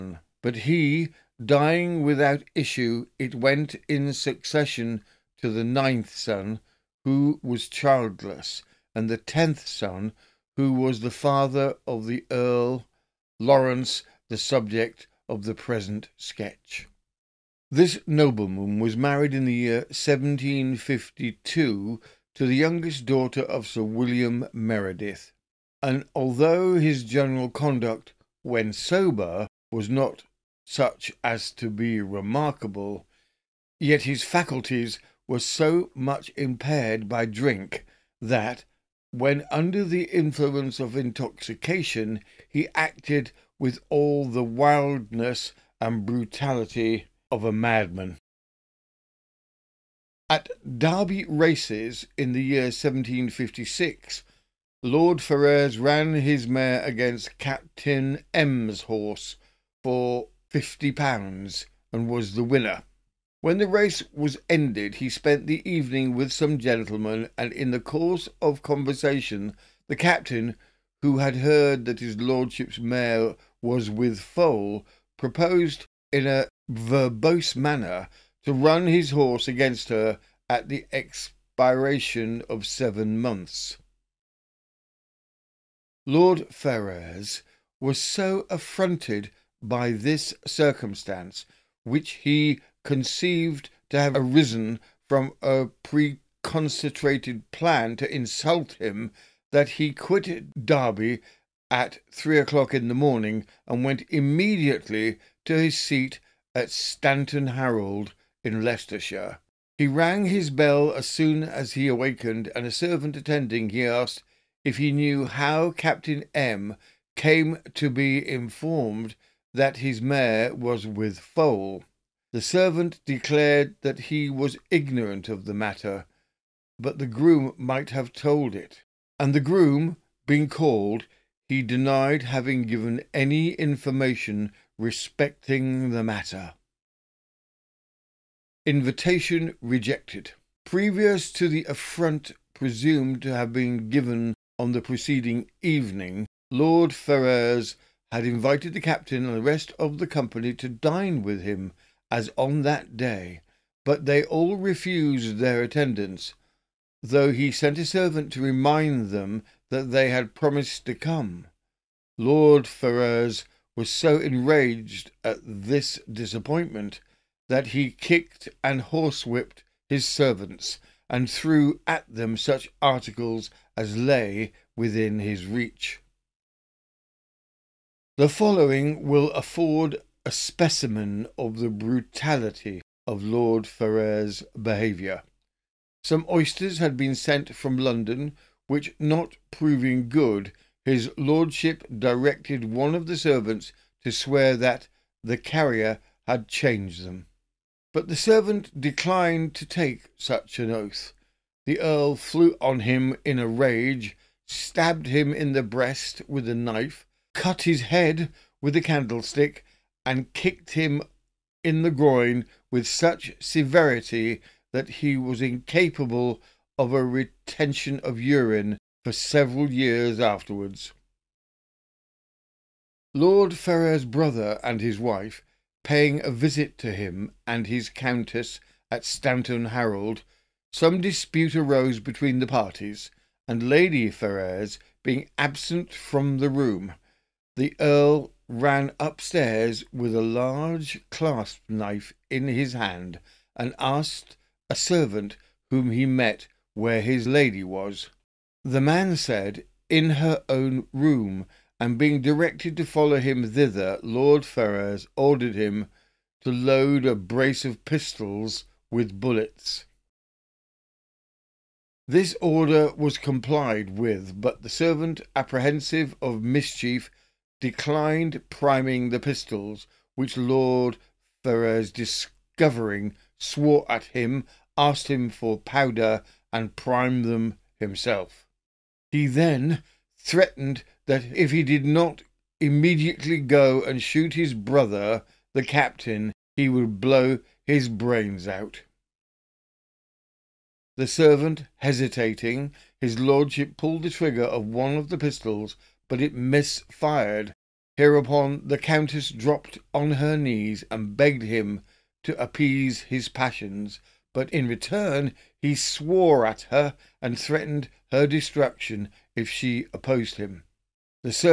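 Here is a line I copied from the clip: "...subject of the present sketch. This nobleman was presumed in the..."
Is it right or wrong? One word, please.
wrong.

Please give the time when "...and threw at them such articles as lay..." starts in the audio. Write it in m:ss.
2:51.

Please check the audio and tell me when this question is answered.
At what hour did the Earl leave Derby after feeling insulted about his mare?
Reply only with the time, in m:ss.
1:42.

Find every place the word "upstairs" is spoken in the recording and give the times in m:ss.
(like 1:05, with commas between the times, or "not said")
3:58.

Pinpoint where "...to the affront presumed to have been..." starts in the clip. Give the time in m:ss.
2:21.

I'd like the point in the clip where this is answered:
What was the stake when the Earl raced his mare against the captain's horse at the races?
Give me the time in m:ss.
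1:00.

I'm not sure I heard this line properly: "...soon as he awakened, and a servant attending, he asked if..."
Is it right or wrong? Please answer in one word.
right.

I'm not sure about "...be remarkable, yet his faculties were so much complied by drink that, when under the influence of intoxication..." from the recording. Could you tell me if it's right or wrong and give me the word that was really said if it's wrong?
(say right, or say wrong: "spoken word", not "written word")
wrong: "impaired", not "complied".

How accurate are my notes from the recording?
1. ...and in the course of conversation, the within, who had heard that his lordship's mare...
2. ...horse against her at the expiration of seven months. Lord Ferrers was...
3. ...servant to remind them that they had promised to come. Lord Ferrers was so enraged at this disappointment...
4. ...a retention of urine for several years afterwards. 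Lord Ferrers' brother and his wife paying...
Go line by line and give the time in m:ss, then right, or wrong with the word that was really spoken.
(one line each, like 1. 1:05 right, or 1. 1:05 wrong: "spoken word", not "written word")
1. 1:07 wrong: "captain", not "within"
2. 1:19 right
3. 2:37 right
4. 3:36 right.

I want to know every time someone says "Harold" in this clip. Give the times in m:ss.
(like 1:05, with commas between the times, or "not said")
1:47, 3:49.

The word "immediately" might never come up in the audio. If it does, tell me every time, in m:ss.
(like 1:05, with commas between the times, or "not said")
1:44, 4:42.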